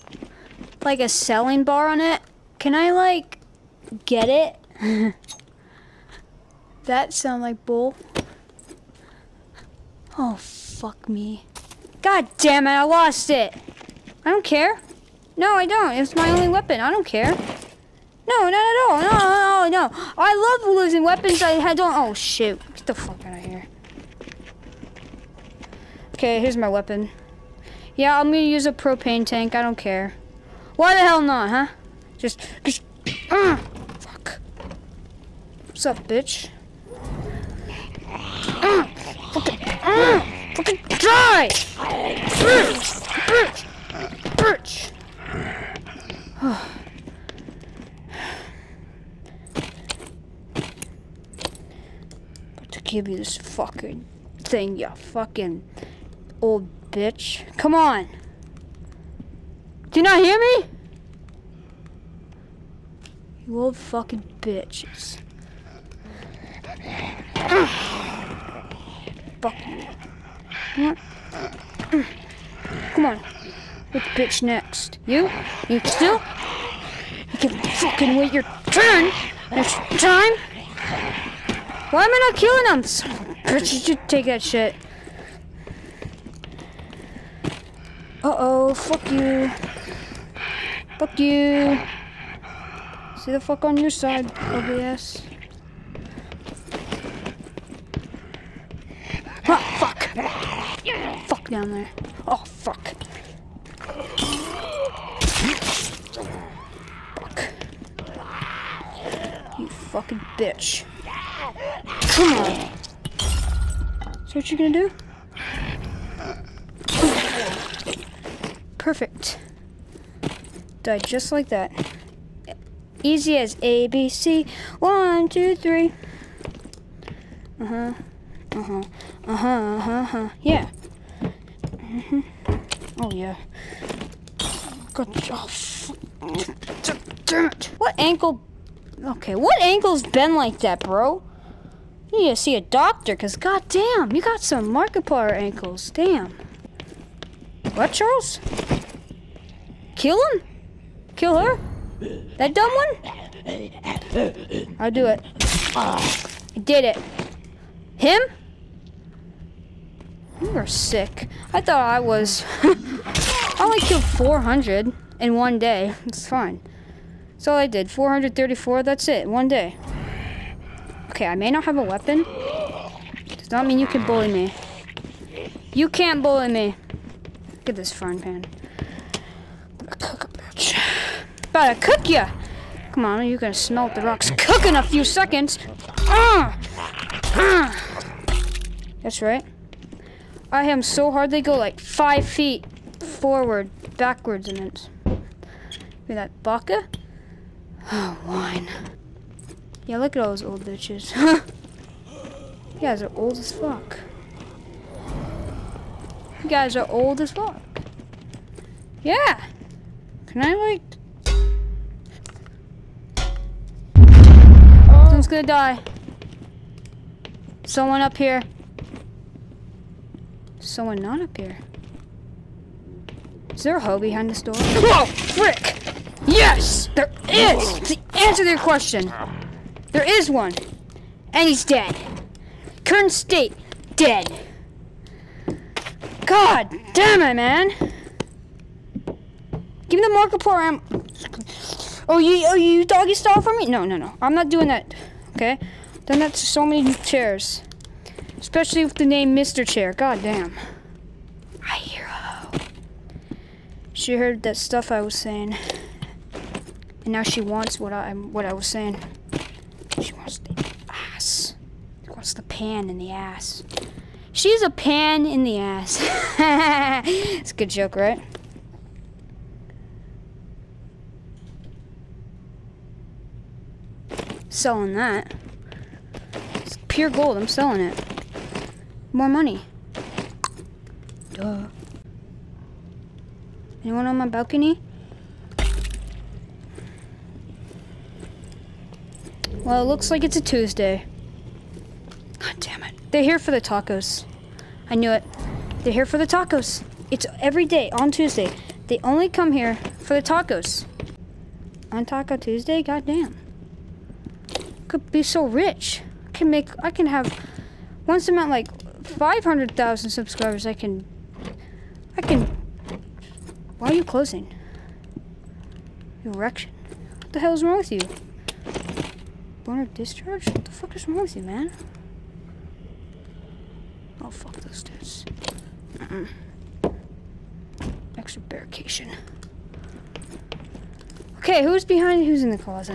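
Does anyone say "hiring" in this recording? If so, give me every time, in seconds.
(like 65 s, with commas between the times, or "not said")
not said.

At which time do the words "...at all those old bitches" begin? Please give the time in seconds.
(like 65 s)
200 s.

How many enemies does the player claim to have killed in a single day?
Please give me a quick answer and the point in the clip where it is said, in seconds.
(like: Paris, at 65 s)
434, at 167 s.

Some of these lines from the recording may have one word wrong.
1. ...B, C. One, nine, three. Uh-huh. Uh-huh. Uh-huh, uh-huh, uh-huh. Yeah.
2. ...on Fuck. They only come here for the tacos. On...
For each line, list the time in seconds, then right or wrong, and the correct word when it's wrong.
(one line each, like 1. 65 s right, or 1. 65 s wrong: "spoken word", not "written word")
1. 123 s wrong: "two", not "nine"
2. 297 s wrong: "Tuesday", not "Fuck".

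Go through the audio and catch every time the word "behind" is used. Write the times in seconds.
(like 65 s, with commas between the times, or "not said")
223 s, 331 s.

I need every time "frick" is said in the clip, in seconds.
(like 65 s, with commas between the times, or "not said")
225 s.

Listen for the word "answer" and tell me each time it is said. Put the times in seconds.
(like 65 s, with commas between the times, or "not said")
228 s.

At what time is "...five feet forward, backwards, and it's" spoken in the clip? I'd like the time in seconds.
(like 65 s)
191 s.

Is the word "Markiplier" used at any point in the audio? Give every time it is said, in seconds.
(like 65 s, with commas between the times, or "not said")
144 s, 240 s.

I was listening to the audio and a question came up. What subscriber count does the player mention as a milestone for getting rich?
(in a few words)
500,000.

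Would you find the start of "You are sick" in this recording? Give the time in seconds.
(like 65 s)
160 s.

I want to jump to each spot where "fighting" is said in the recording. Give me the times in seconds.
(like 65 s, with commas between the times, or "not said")
not said.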